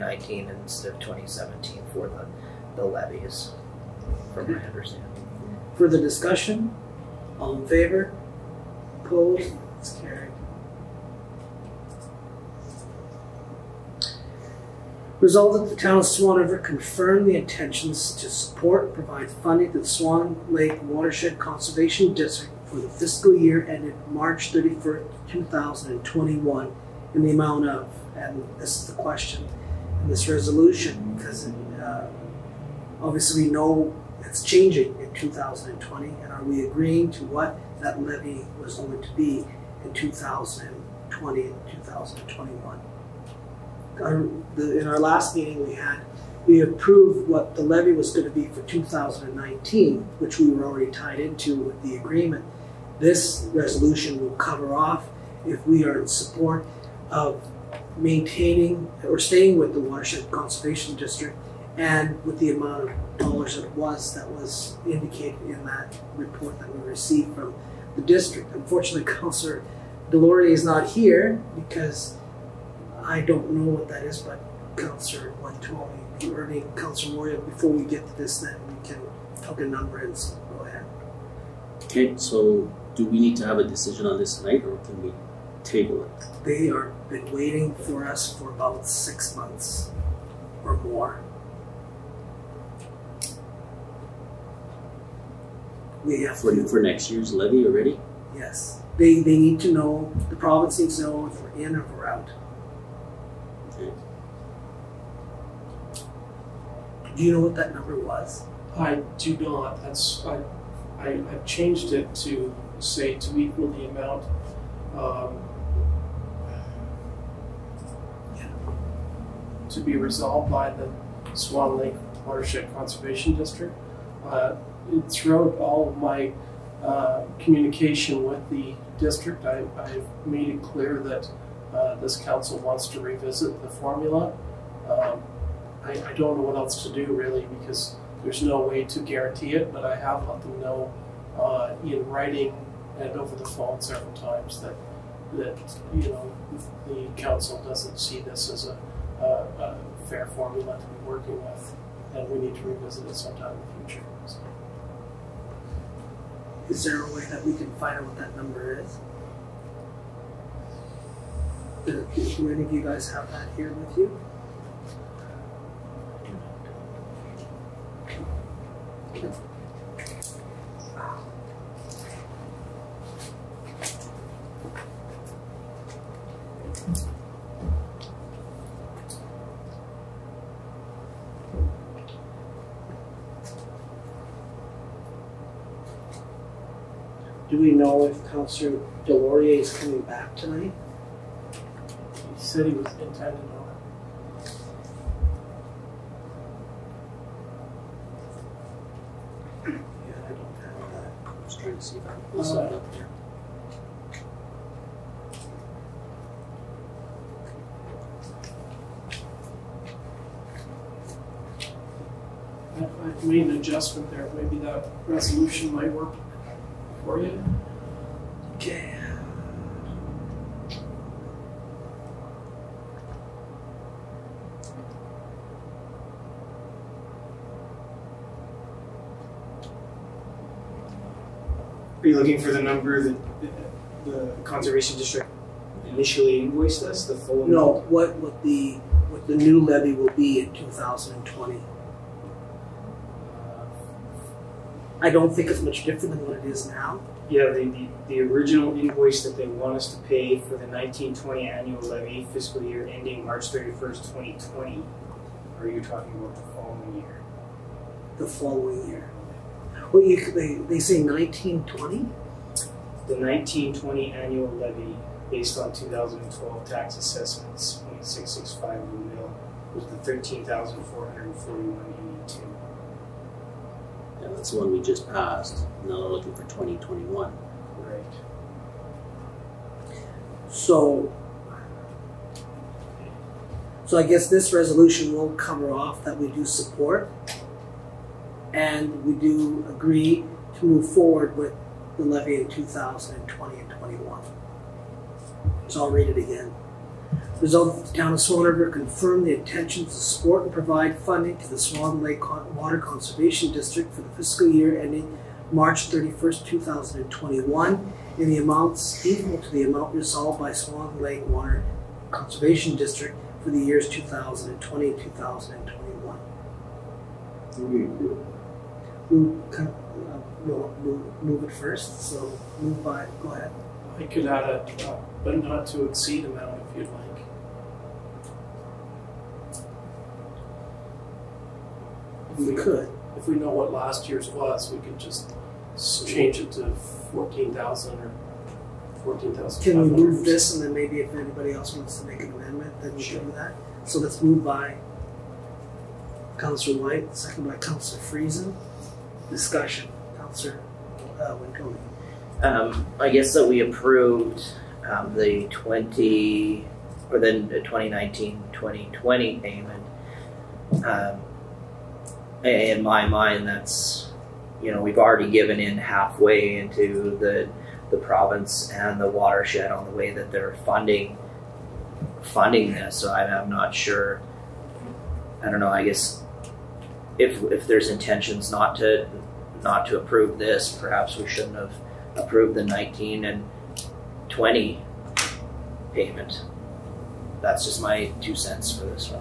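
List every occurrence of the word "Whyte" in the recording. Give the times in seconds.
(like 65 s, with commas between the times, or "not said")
346 s.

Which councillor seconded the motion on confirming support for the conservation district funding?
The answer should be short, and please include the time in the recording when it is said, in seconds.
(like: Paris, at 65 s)
Councillor Friesen, at 347 s.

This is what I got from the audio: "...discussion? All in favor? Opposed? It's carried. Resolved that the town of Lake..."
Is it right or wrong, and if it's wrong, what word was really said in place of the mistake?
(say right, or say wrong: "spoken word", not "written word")
wrong: "Swan", not "Lake".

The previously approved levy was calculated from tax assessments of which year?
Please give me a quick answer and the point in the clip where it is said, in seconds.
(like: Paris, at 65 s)
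2012, at 265 s.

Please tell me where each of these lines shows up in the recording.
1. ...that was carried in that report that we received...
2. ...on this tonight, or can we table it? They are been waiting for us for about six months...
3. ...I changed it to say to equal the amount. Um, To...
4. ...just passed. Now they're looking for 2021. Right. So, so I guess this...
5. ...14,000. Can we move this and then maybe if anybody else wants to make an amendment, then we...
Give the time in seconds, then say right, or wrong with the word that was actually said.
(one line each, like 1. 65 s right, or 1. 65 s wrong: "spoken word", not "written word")
1. 64 s wrong: "indicated", not "carried"
2. 84 s right
3. 111 s right
4. 274 s right
5. 339 s right.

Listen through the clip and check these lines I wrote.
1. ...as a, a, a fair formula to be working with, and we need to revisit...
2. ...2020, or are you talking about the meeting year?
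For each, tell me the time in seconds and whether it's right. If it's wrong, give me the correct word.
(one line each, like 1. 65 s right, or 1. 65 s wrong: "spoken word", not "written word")
1. 148 s right
2. 254 s wrong: "following", not "meeting".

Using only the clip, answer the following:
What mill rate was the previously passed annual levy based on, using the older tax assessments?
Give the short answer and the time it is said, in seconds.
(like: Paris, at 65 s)
0.665 mil, at 268 s.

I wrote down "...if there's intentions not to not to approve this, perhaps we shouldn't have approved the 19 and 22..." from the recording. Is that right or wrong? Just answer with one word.
wrong.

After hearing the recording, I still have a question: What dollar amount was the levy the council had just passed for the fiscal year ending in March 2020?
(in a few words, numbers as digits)
13,441.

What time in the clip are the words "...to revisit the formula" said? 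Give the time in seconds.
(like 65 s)
132 s.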